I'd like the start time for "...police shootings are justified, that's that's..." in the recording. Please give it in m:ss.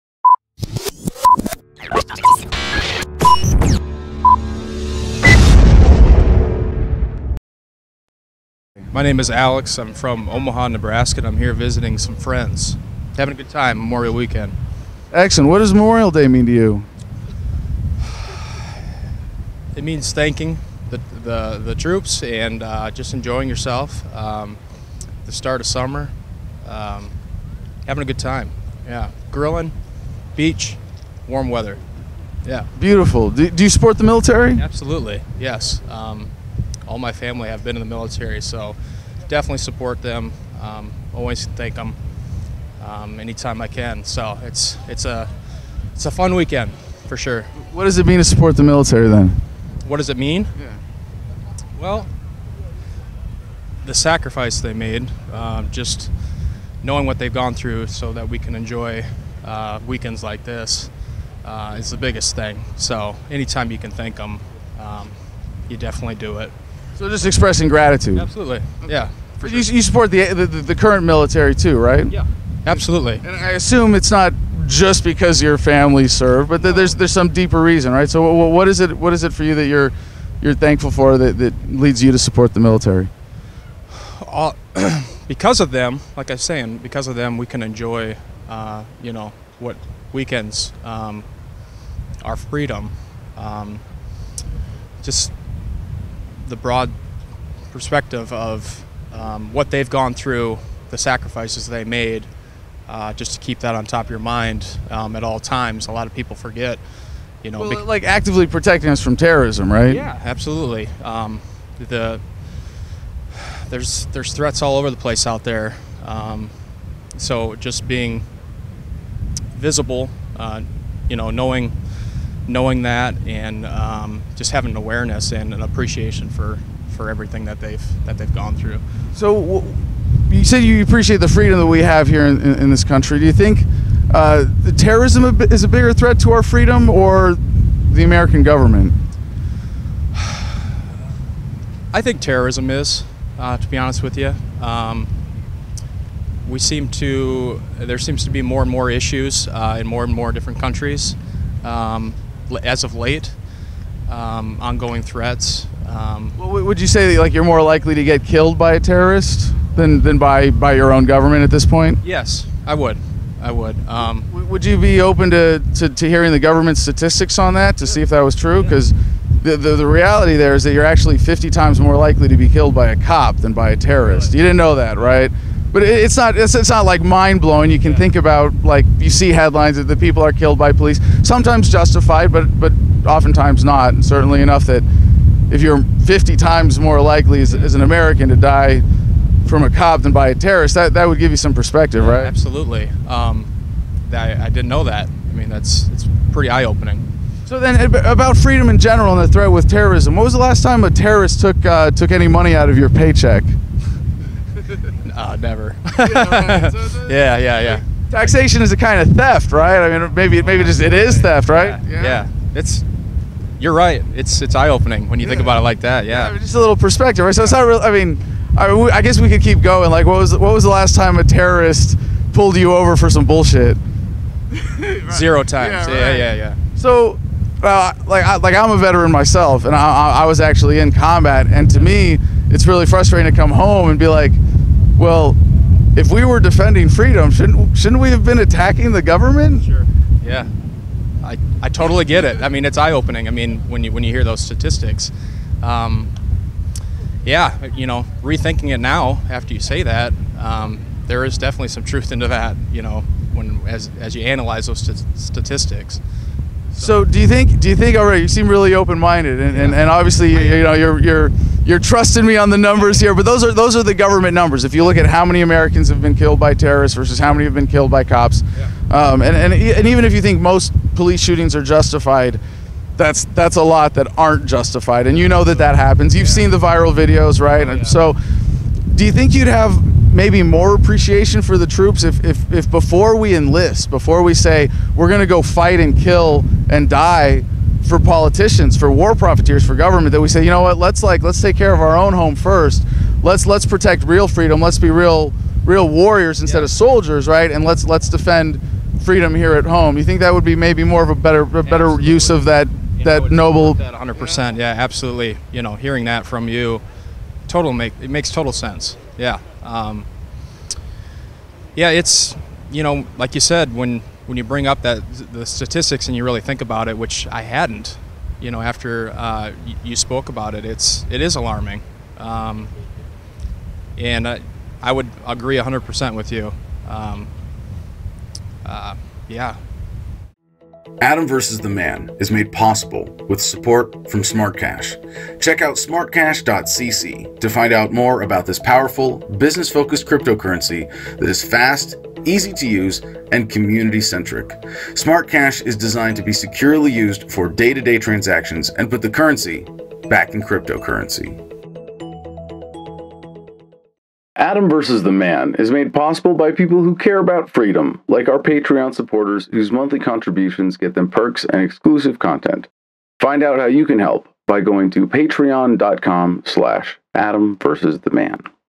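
4:30.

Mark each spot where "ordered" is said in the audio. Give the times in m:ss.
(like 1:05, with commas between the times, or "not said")
not said.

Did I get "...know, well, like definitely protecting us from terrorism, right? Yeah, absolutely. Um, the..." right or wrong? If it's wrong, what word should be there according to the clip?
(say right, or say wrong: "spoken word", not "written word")
wrong: "actively", not "definitely".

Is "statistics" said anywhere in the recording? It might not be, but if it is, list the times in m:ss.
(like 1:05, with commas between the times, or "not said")
2:46, 4:04, 4:15, 5:15.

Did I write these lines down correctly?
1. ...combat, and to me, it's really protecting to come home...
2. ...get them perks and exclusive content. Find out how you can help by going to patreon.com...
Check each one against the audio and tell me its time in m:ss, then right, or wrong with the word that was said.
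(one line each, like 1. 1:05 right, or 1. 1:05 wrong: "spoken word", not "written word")
1. 3:50 wrong: "frustrating", not "protecting"
2. 6:00 right.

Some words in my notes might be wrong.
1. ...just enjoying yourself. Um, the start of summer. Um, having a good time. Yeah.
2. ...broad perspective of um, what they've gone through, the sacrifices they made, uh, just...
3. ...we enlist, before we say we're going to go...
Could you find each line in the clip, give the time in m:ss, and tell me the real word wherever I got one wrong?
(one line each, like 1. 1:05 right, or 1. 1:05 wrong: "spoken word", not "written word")
1. 0:22 right
2. 1:36 right
3. 4:43 right.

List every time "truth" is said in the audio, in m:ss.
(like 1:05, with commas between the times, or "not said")
4:11.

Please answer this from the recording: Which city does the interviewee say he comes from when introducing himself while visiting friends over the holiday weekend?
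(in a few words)
Omaha.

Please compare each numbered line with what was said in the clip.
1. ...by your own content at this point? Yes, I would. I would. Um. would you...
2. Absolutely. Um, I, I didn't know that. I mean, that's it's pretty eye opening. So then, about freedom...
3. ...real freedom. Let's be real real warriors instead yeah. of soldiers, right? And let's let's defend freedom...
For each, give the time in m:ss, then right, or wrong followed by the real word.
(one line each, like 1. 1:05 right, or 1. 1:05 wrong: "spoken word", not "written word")
1. 2:40 wrong: "government", not "content"
2. 3:12 right
3. 4:54 right.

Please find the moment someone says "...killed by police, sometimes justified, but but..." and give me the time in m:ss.
3:00.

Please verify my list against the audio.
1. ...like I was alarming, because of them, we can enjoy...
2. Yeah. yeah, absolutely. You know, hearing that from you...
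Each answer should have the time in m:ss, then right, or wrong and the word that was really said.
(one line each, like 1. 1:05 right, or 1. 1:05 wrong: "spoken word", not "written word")
1. 1:26 wrong: "saying", not "alarming"
2. 5:04 right.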